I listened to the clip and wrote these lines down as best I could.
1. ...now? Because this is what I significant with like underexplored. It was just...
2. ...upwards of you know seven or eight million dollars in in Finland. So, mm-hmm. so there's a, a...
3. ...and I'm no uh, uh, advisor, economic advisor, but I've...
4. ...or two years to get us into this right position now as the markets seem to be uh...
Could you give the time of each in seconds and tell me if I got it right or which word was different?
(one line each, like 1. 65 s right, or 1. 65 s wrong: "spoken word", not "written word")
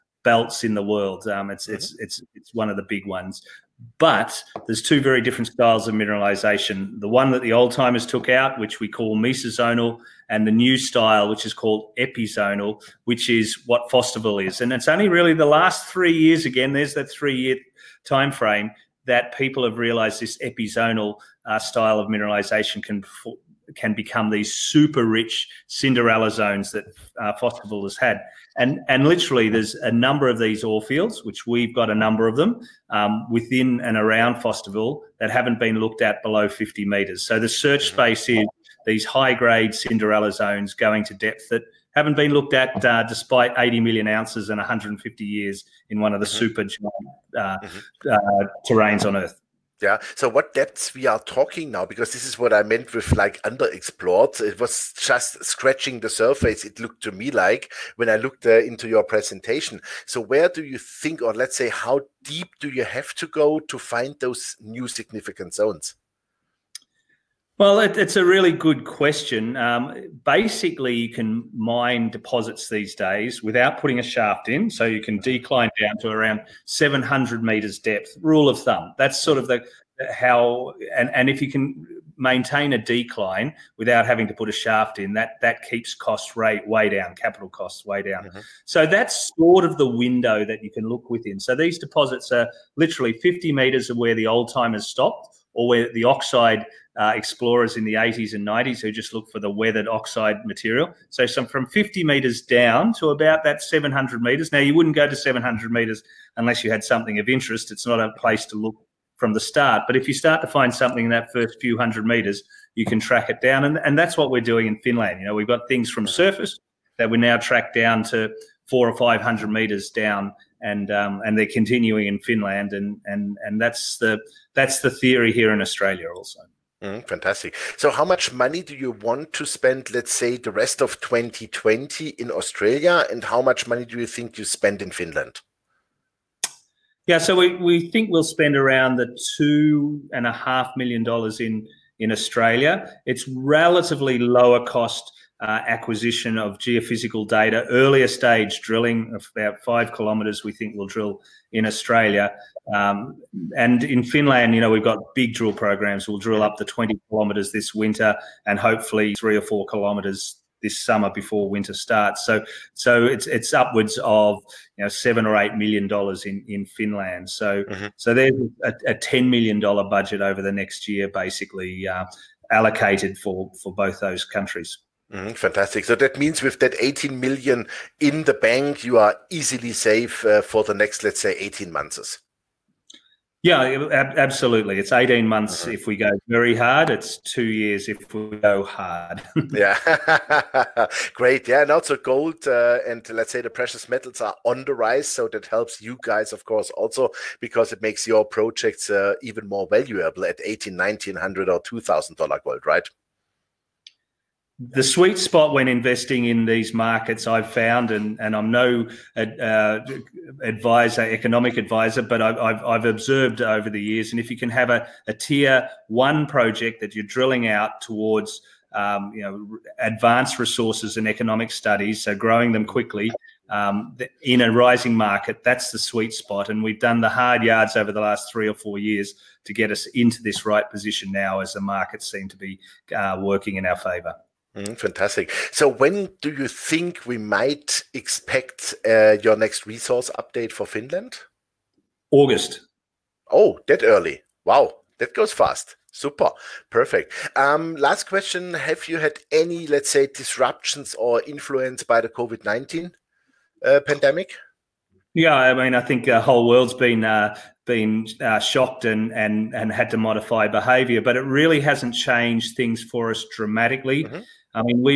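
1. 51 s wrong: "meant", not "significant"
2. 163 s right
3. 208 s right
4. 228 s wrong: "four", not "two".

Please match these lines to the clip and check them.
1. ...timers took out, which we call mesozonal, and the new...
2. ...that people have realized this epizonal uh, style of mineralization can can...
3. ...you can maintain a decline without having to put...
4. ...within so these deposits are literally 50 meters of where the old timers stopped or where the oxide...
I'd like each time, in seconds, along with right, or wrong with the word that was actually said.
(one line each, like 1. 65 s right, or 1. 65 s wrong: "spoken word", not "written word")
1. 7 s right
2. 19 s right
3. 81 s right
4. 91 s right.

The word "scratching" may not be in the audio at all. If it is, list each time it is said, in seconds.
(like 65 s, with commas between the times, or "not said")
55 s.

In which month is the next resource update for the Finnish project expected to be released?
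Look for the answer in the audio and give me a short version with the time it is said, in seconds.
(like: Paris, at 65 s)
August, at 242 s.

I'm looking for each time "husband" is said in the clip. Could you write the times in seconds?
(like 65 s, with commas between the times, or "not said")
not said.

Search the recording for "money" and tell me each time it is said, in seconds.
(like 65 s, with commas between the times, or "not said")
128 s, 133 s.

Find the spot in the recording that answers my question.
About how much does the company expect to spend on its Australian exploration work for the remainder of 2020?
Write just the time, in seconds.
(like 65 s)
139 s.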